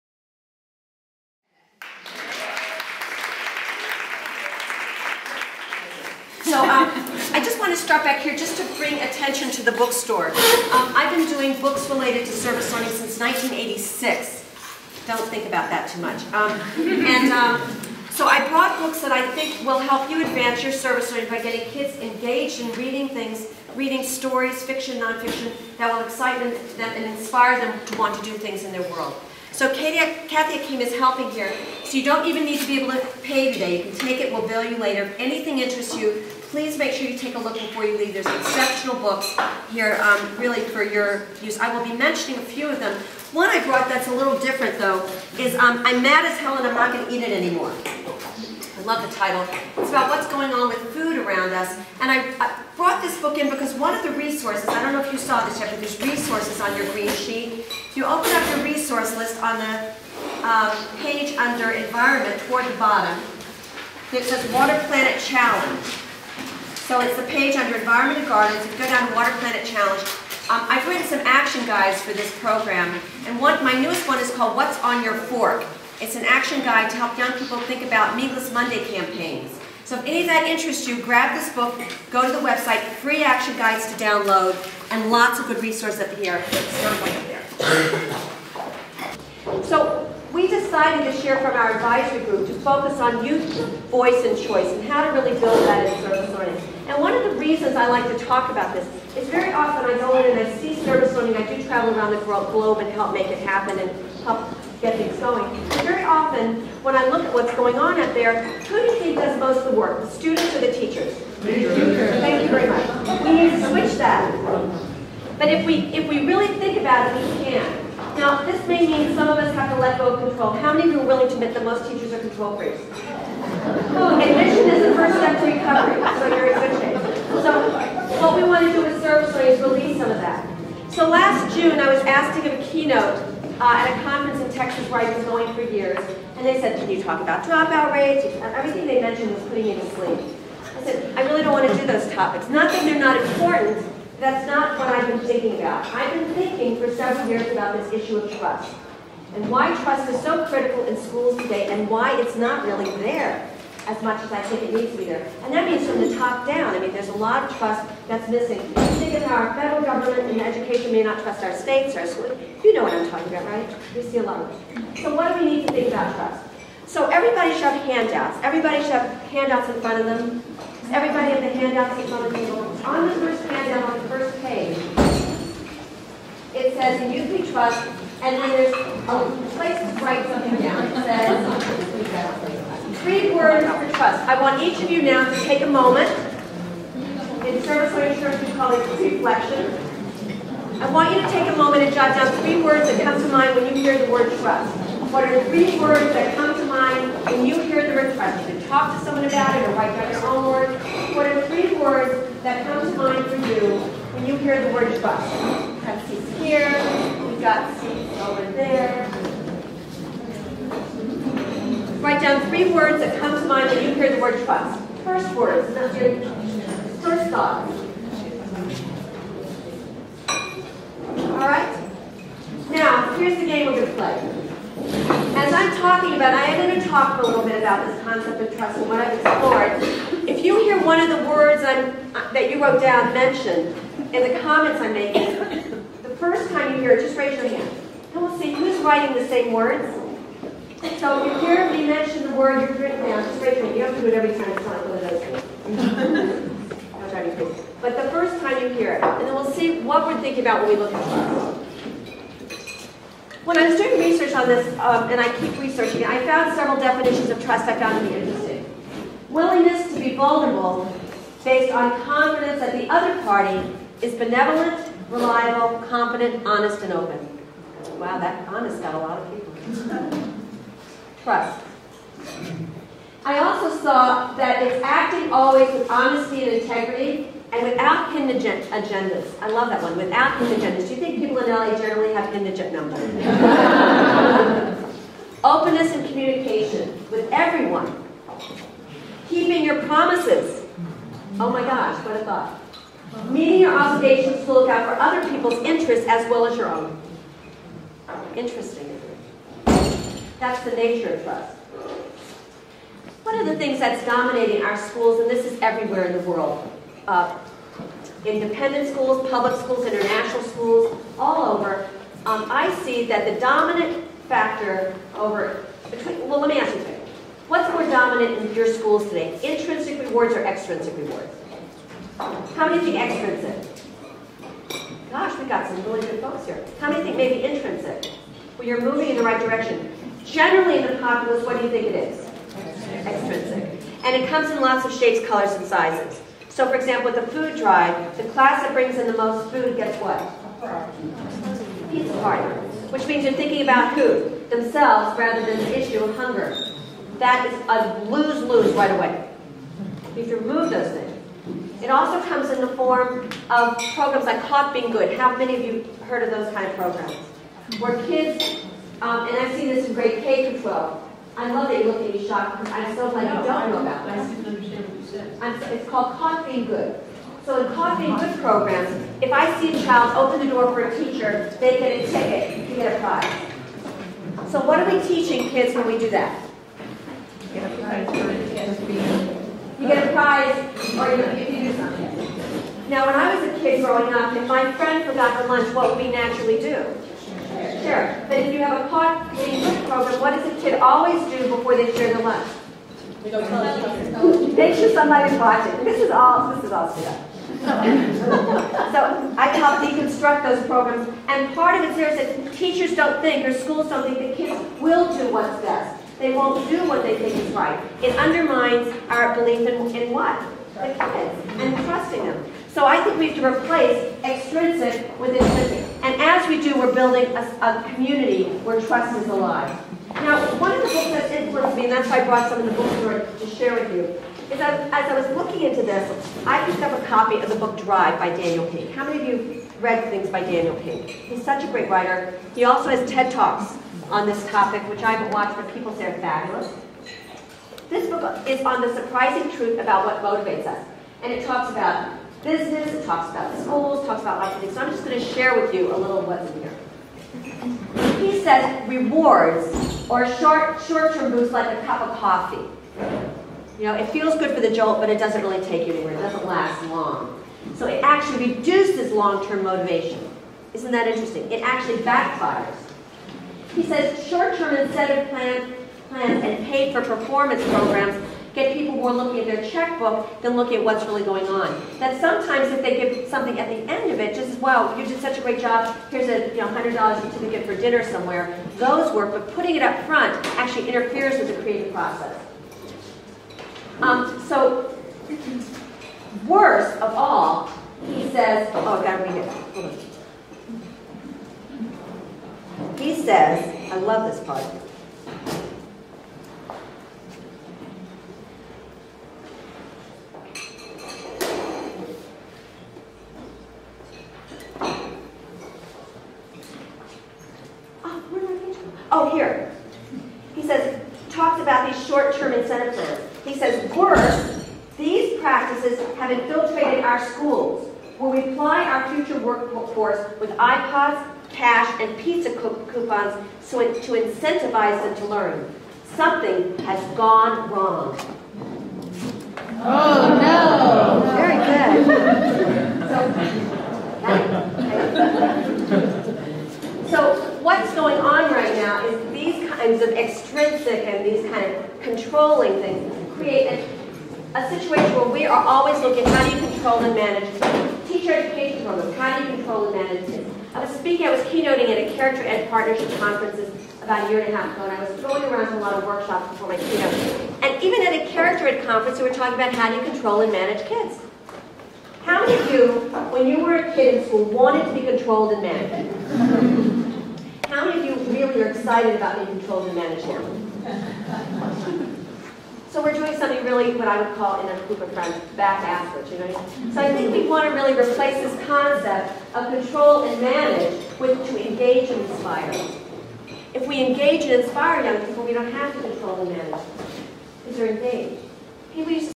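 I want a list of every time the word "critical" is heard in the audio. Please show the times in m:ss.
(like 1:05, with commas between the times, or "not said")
2:30.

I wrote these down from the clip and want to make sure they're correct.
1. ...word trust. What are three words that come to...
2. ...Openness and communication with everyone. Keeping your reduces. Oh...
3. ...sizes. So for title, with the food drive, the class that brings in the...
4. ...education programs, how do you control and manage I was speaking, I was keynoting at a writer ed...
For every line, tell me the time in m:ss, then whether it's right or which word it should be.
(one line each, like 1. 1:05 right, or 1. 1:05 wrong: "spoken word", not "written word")
1. 3:14 right
2. 4:45 wrong: "promises", not "reduces"
3. 5:35 wrong: "example", not "title"
4. 9:08 wrong: "character", not "writer".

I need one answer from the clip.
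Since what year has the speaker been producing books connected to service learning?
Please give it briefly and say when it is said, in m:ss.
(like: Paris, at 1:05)
1986, at 0:13.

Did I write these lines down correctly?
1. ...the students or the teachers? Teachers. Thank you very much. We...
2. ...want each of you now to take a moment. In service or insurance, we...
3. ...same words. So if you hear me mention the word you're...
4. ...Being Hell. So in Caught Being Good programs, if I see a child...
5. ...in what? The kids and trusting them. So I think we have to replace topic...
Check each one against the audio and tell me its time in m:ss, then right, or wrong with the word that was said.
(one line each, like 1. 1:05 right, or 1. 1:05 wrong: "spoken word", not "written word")
1. 1:49 right
2. 3:04 right
3. 3:59 right
4. 6:06 wrong: "Good", not "Hell"
5. 6:49 wrong: "extrinsic", not "topic".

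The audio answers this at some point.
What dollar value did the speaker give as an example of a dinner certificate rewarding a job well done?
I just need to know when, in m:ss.
7:56.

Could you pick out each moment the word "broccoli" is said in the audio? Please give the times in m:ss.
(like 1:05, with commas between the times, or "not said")
not said.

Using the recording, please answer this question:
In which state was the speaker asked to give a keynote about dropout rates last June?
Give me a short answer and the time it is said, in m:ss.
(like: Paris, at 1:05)
Texas, at 2:14.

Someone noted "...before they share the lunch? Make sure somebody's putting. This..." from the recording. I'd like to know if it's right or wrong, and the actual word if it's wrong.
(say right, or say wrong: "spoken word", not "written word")
wrong: "watching", not "putting".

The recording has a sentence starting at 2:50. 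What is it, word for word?
Everybody have the handouts in front of them.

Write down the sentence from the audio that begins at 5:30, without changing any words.
Generally in the populace, what do you think it is?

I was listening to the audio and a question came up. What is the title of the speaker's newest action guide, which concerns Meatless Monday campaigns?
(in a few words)
What's on Your Fork.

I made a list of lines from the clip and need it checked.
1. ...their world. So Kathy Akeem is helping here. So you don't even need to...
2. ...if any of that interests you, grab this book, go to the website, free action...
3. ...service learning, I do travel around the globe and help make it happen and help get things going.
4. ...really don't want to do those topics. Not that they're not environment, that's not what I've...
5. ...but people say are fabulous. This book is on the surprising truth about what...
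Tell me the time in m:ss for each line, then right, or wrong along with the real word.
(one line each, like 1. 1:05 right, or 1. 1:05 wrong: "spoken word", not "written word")
1. 0:28 right
2. 1:19 right
3. 1:40 right
4. 2:21 wrong: "important", not "environment"
5. 7:15 right.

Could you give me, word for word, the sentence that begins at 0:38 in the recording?
There's exceptional books here um, really for your use.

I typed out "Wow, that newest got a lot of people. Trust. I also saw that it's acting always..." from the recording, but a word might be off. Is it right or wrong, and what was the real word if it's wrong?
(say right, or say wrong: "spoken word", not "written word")
wrong: "honest", not "newest".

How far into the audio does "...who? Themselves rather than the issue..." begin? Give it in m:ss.
5:43.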